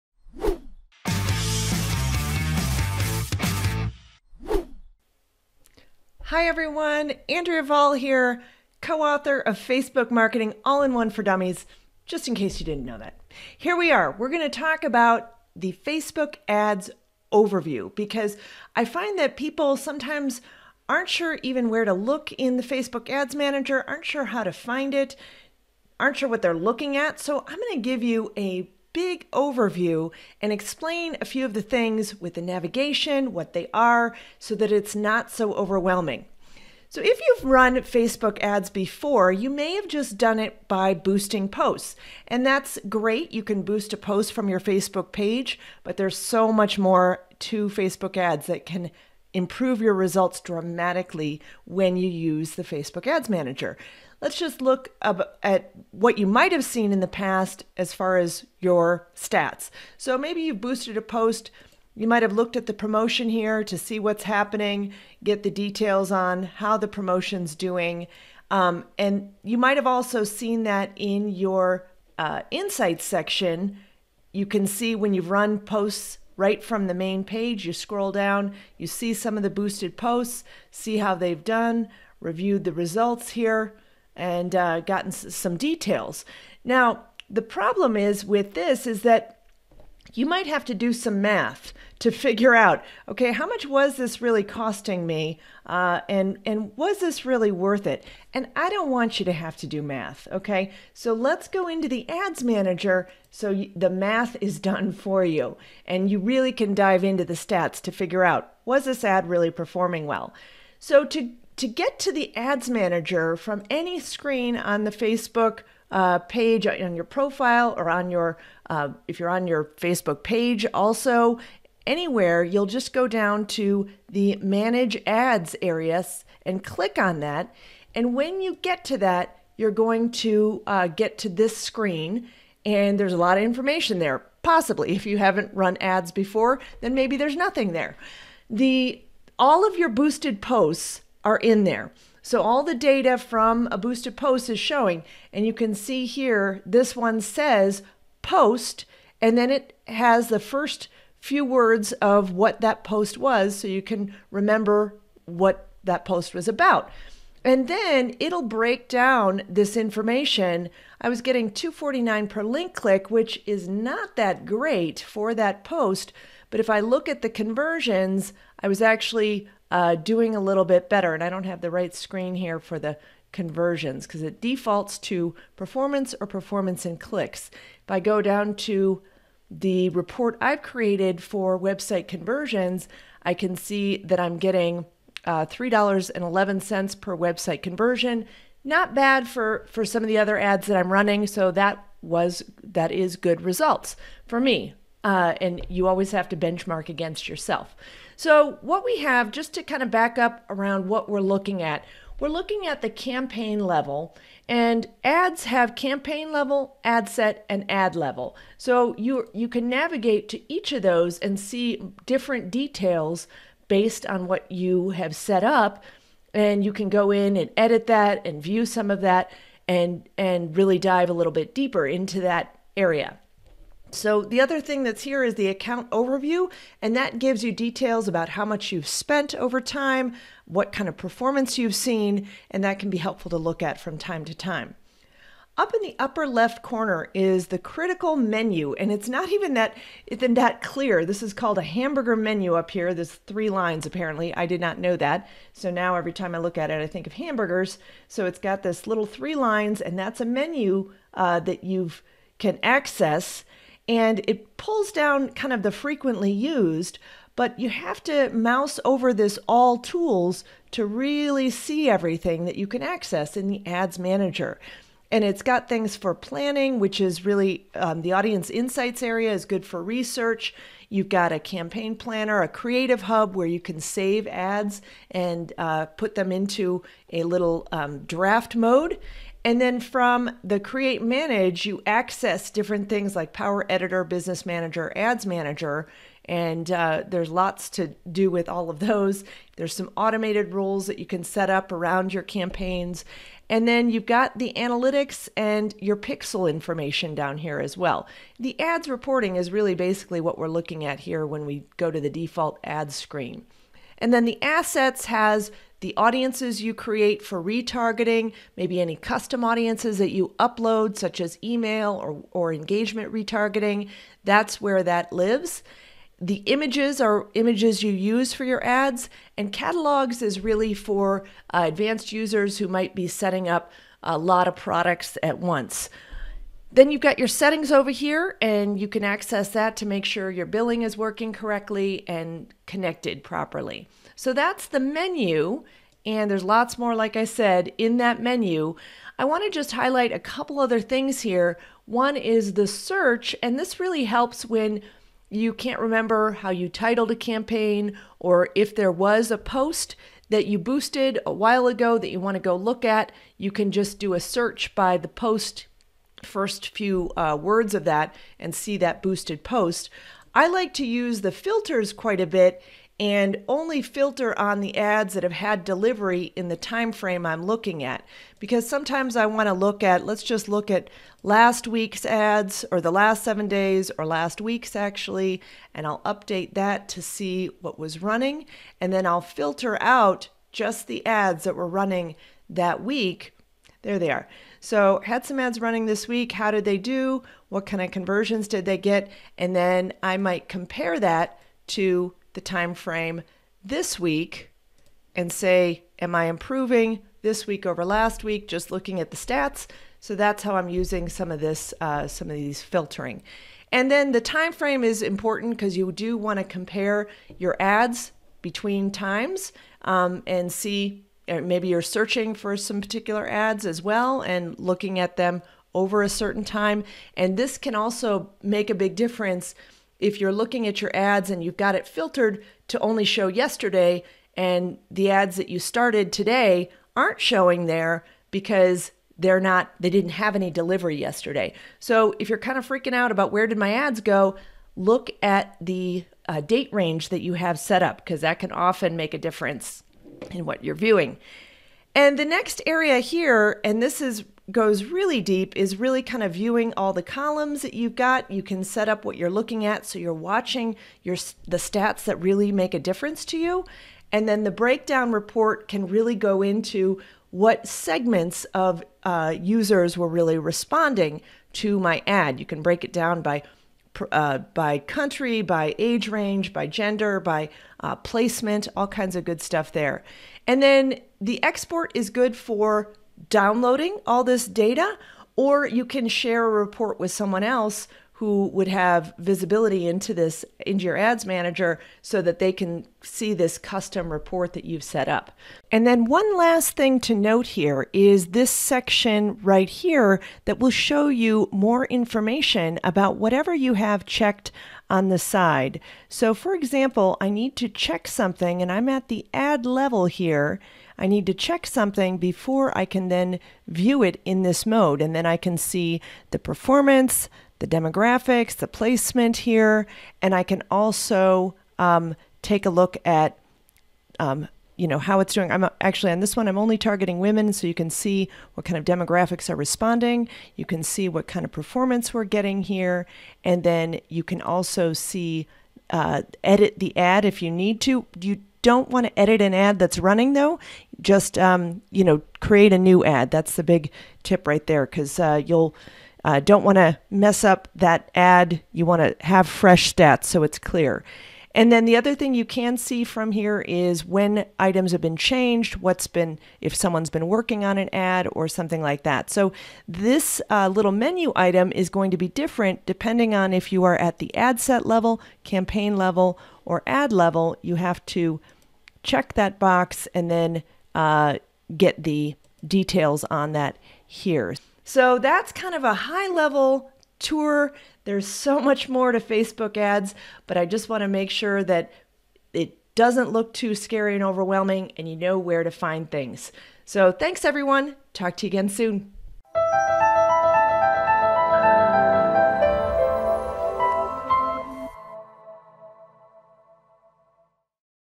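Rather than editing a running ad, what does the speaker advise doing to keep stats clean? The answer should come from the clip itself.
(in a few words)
create a new ad.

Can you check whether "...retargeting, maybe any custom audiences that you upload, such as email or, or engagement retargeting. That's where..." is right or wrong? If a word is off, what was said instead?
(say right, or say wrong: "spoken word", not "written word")
right.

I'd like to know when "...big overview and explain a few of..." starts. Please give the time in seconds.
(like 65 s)
28 s.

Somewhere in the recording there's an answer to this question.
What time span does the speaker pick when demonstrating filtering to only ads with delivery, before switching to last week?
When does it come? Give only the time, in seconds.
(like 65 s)
372 s.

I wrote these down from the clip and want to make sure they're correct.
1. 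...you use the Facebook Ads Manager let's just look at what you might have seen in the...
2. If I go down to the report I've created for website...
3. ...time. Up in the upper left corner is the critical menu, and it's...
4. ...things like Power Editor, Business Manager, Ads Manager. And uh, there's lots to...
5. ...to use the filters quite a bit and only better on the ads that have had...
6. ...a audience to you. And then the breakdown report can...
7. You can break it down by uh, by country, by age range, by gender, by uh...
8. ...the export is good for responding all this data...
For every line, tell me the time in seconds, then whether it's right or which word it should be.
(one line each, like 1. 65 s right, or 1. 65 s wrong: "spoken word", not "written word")
1. 51 s right
2. 177 s right
3. 234 s right
4. 282 s right
5. 360 s wrong: "filter", not "better"
6. 452 s wrong: "difference", not "audience"
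7. 462 s right
8. 471 s wrong: "downloading", not "responding".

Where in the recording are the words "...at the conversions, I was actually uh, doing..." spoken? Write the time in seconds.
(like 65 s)
167 s.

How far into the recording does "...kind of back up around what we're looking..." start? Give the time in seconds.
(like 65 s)
199 s.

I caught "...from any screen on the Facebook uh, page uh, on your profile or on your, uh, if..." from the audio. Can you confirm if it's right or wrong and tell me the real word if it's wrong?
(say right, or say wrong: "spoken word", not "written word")
right.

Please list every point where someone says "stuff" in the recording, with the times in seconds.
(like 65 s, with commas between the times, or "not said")
469 s.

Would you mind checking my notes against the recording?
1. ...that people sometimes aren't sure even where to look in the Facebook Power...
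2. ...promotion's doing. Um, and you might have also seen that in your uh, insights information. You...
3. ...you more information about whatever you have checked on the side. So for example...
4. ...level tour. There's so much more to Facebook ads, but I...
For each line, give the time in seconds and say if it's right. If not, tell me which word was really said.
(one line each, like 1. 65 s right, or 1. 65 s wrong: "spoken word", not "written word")
1. 19 s wrong: "Ads", not "Power"
2. 66 s wrong: "section", not "information"
3. 491 s right
4. 566 s right.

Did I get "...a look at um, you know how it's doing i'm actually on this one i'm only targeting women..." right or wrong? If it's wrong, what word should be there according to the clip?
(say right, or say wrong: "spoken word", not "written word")
right.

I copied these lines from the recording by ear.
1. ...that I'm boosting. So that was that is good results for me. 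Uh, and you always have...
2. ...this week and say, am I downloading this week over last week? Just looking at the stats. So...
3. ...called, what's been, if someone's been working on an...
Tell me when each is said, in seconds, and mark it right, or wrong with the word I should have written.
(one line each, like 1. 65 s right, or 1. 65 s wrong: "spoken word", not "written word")
1. 190 s wrong: "running", not "boosting"
2. 393 s wrong: "improving", not "downloading"
3. 545 s wrong: "changed", not "called".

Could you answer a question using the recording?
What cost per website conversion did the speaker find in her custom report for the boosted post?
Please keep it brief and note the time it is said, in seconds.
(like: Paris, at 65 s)
$3.11, at 185 s.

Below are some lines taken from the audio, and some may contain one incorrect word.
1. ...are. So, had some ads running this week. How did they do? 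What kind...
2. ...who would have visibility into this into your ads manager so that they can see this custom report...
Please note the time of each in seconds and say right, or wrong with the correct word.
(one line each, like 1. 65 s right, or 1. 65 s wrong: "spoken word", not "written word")
1. 384 s right
2. 478 s right.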